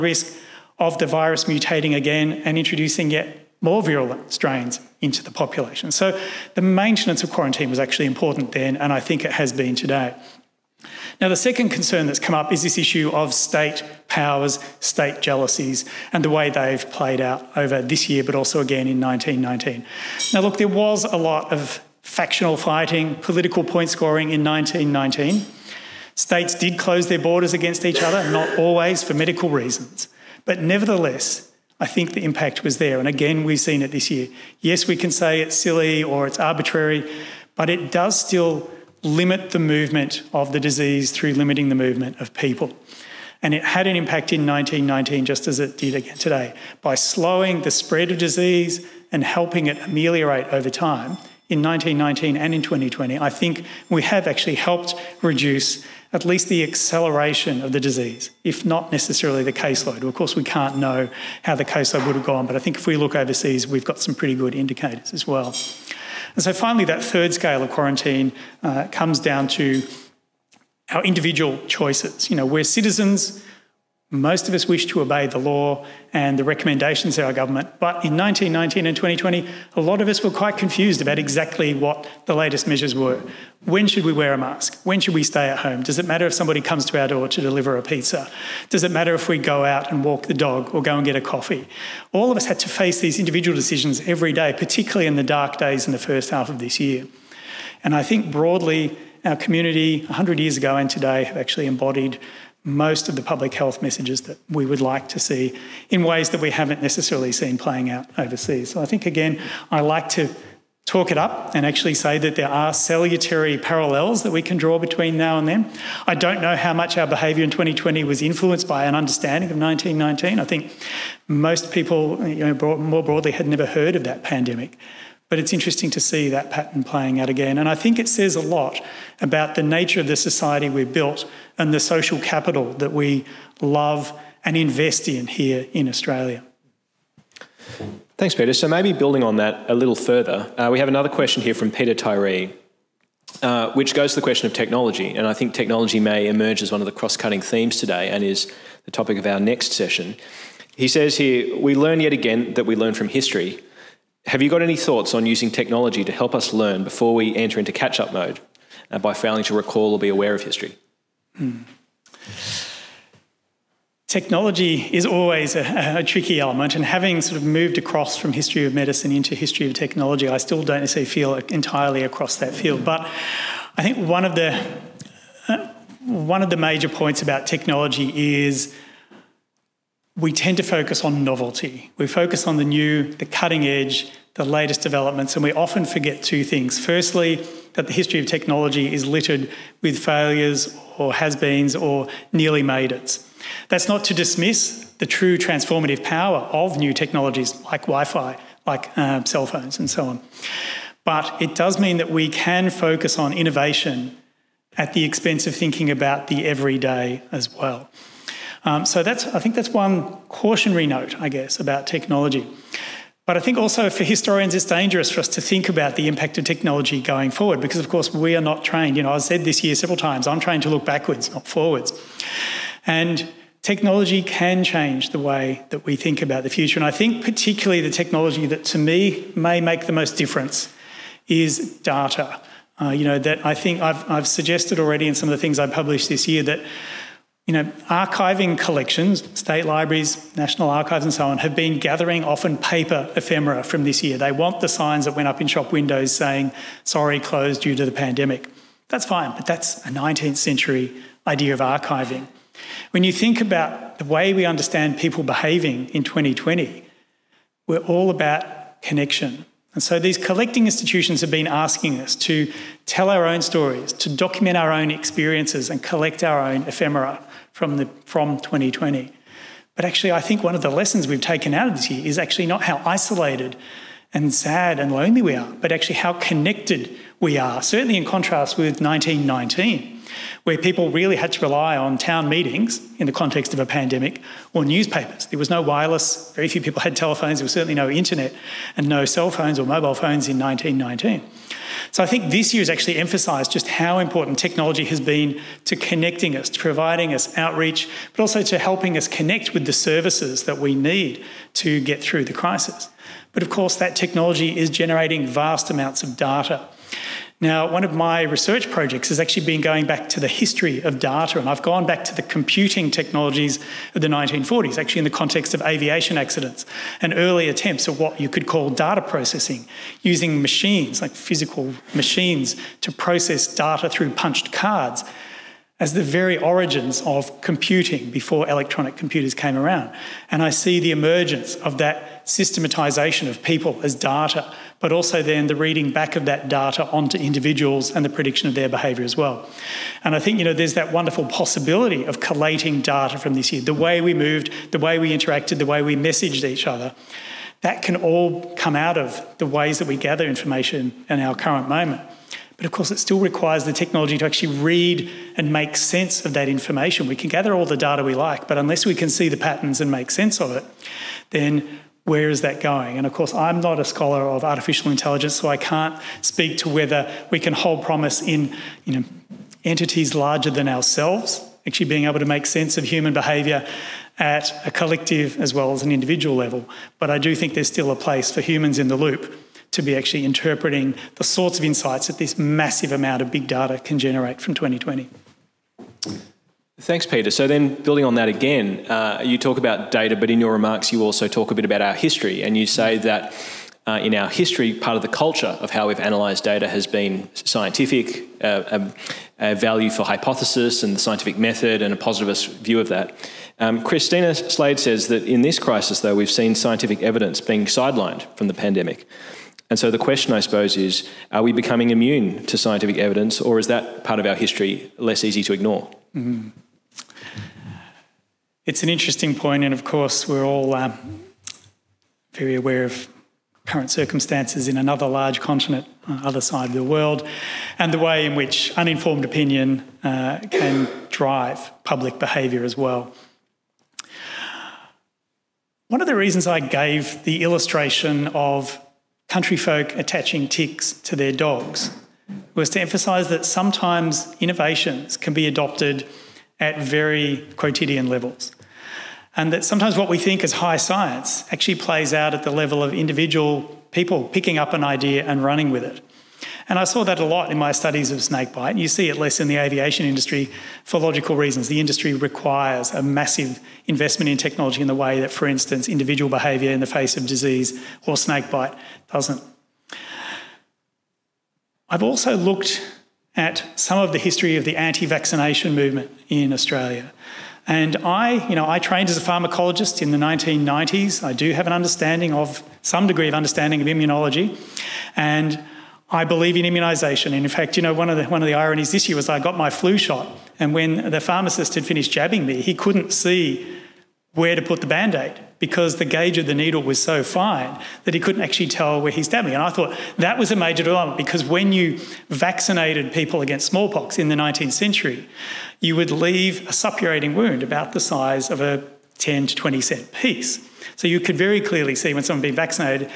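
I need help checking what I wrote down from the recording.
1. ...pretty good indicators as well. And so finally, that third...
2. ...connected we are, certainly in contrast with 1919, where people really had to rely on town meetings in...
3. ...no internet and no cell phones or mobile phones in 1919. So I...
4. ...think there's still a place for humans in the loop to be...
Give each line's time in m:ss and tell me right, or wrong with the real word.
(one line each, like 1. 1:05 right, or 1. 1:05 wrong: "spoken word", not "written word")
1. 1:04 right
2. 4:36 right
3. 4:47 right
4. 6:17 right.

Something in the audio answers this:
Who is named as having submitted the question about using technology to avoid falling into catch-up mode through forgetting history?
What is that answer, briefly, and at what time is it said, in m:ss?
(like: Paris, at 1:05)
Peter Tyree, at 2:21.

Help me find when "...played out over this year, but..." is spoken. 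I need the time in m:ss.
0:16.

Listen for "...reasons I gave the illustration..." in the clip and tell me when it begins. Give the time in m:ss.
7:16.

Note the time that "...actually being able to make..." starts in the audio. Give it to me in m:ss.
6:11.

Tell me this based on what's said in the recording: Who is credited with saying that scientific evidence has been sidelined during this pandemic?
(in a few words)
Christina Slade.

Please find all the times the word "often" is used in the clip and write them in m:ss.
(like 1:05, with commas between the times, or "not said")
3:05, 4:02.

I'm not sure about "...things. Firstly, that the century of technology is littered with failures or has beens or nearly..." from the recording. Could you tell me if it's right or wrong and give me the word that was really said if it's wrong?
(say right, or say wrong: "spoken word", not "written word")
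wrong: "history", not "century".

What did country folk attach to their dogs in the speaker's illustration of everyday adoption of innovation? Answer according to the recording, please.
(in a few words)
Ticks.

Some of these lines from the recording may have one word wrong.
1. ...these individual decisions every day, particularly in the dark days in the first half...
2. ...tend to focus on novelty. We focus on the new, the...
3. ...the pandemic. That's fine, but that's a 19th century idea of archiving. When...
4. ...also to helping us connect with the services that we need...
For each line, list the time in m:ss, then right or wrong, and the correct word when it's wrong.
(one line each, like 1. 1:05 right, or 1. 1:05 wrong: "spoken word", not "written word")
1. 1:33 right
2. 3:00 right
3. 4:07 right
4. 4:58 right.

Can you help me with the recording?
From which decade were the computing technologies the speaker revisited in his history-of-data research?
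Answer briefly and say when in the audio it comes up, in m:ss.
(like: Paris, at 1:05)
1940s, at 5:14.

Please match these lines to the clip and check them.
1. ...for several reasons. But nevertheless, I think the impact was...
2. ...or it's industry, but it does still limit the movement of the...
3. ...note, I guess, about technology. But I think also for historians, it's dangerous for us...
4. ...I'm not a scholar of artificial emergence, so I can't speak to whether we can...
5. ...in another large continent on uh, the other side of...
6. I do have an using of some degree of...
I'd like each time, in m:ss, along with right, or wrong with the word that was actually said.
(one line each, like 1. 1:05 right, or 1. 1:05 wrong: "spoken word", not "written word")
1. 0:29 wrong: "medical", not "several"
2. 0:36 wrong: "arbitrary", not "industry"
3. 3:30 right
4. 6:03 wrong: "intelligence", not "emergence"
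5. 7:04 right
6. 8:01 wrong: "understanding", not "using".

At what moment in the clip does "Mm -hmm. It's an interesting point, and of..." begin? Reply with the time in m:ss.
6:56.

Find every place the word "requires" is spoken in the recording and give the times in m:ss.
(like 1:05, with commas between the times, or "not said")
5:53, 7:42.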